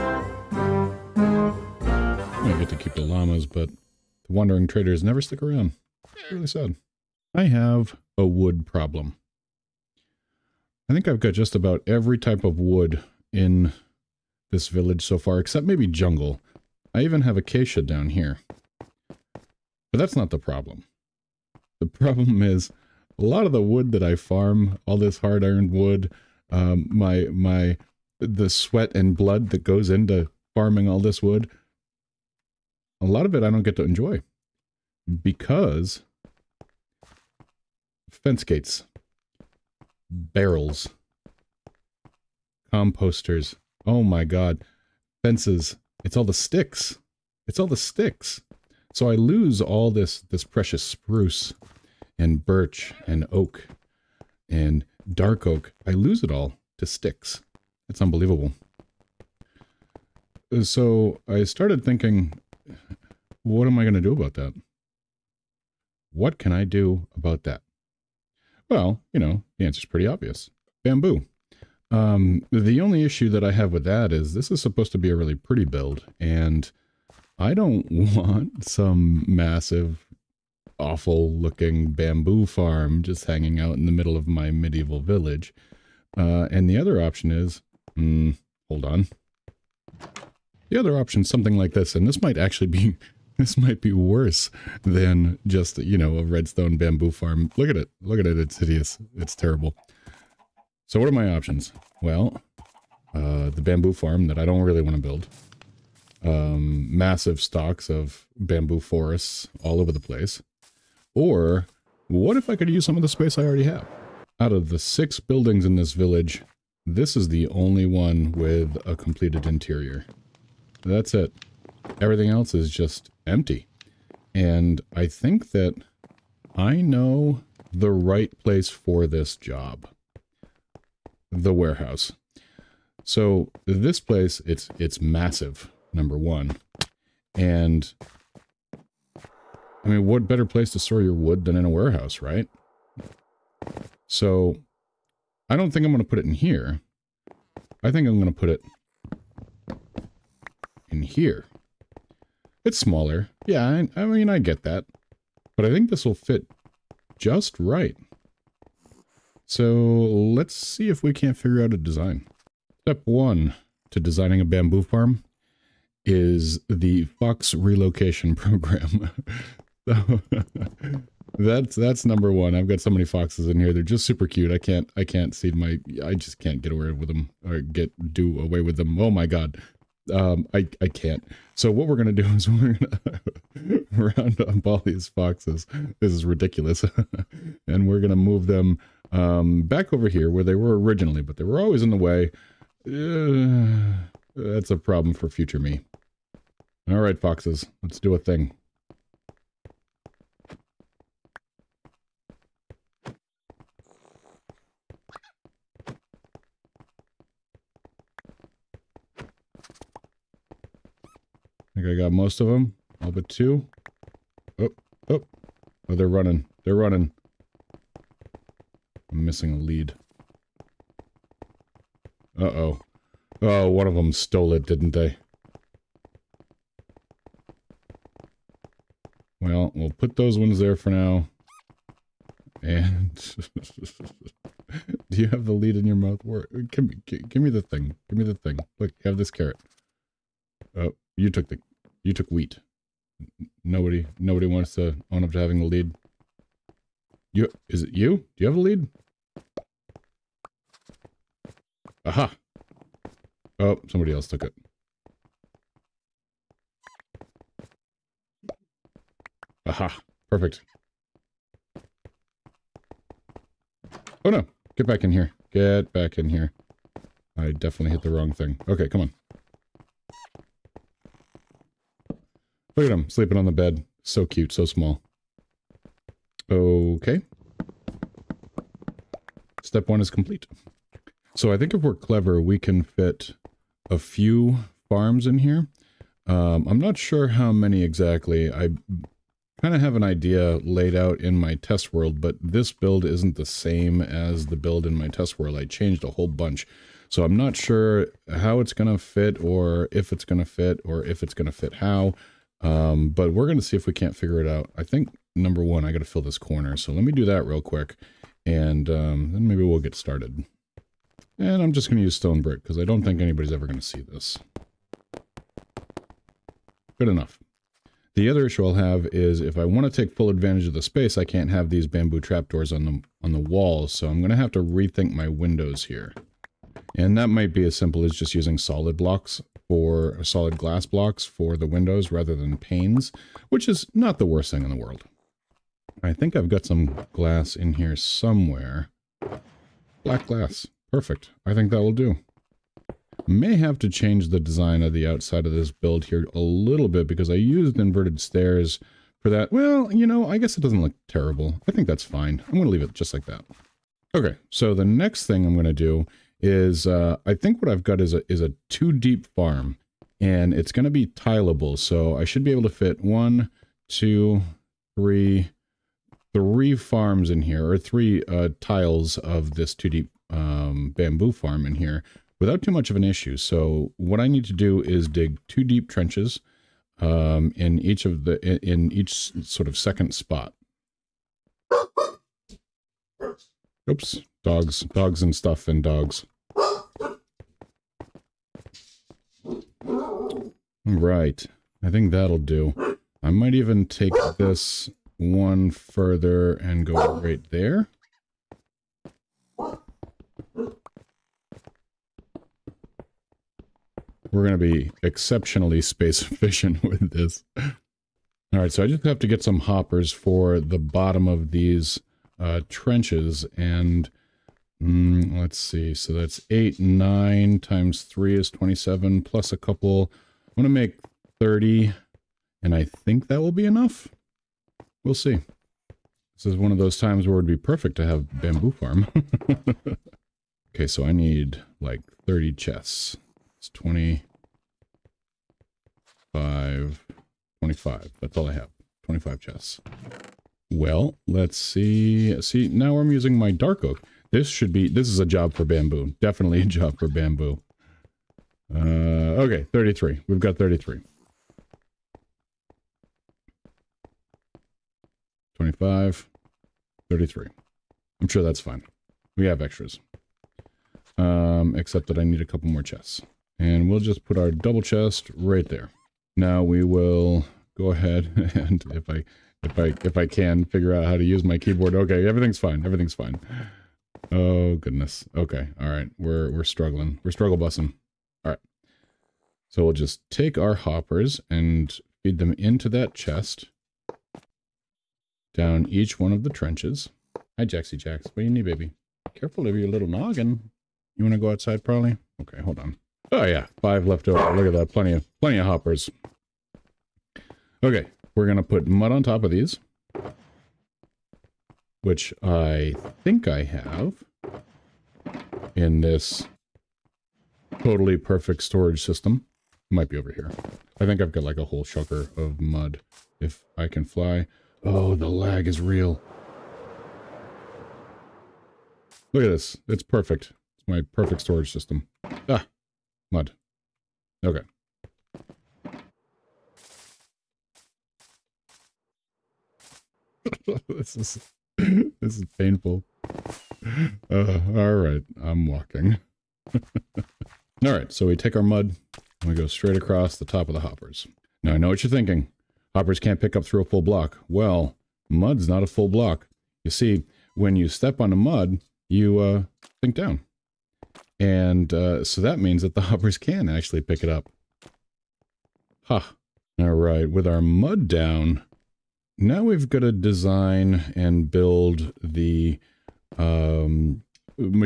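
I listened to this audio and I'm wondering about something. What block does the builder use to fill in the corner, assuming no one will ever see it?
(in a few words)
Stone brick.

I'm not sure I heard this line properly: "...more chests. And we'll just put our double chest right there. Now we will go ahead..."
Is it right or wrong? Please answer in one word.
right.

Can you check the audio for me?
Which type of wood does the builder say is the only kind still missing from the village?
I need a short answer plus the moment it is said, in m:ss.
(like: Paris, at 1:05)
Jungle, at 0:15.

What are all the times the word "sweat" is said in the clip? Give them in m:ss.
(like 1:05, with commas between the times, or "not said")
0:28.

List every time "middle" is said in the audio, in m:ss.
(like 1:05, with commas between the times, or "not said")
1:23.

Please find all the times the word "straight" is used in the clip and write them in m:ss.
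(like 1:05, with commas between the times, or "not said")
8:59.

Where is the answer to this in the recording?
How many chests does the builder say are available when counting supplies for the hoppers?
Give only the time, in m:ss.
7:19.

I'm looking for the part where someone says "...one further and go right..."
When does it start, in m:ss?
6:35.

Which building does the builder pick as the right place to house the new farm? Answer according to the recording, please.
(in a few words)
The warehouse.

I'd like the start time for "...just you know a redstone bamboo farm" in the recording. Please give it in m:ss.
1:35.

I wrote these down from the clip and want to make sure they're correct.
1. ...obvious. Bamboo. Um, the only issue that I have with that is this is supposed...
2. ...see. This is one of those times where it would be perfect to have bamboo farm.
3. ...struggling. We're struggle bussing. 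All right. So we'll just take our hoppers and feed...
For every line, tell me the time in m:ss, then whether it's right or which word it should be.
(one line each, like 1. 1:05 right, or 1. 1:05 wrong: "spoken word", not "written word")
1. 1:10 right
2. 7:05 right
3. 7:56 right.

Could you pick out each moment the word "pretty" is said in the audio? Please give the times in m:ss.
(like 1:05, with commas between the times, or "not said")
1:09, 1:15.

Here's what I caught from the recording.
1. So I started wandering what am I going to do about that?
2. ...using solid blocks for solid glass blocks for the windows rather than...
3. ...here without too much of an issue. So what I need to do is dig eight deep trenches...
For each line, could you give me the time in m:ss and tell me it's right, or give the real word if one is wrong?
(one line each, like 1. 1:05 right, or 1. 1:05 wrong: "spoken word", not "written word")
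1. 1:00 wrong: "thinking", not "wandering"
2. 5:28 right
3. 6:11 wrong: "two", not "eight".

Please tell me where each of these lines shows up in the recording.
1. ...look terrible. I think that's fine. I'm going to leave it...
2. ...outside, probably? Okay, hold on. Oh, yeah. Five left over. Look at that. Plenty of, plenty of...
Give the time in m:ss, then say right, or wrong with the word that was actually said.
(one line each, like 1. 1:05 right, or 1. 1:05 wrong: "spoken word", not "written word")
1. 5:50 right
2. 8:11 right.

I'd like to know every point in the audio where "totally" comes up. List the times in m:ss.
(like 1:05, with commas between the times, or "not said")
8:27.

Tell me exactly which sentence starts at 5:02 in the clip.
Um, but we're going to see if we can't figure it out.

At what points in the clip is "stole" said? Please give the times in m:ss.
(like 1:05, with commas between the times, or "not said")
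3:44.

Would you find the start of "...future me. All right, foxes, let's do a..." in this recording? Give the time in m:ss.
3:15.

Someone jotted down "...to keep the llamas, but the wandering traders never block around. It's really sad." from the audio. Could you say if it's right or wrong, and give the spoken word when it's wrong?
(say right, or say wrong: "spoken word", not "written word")
wrong: "stick", not "block".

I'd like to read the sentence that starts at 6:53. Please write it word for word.
And mm, let's see, so that's 8, 9 times 3 is 27, plus a couple.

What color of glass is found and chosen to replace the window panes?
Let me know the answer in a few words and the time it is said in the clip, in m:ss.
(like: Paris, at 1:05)
Black, at 5:40.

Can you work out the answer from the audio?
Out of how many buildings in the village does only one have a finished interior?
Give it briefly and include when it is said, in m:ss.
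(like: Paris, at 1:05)
6, at 1:54.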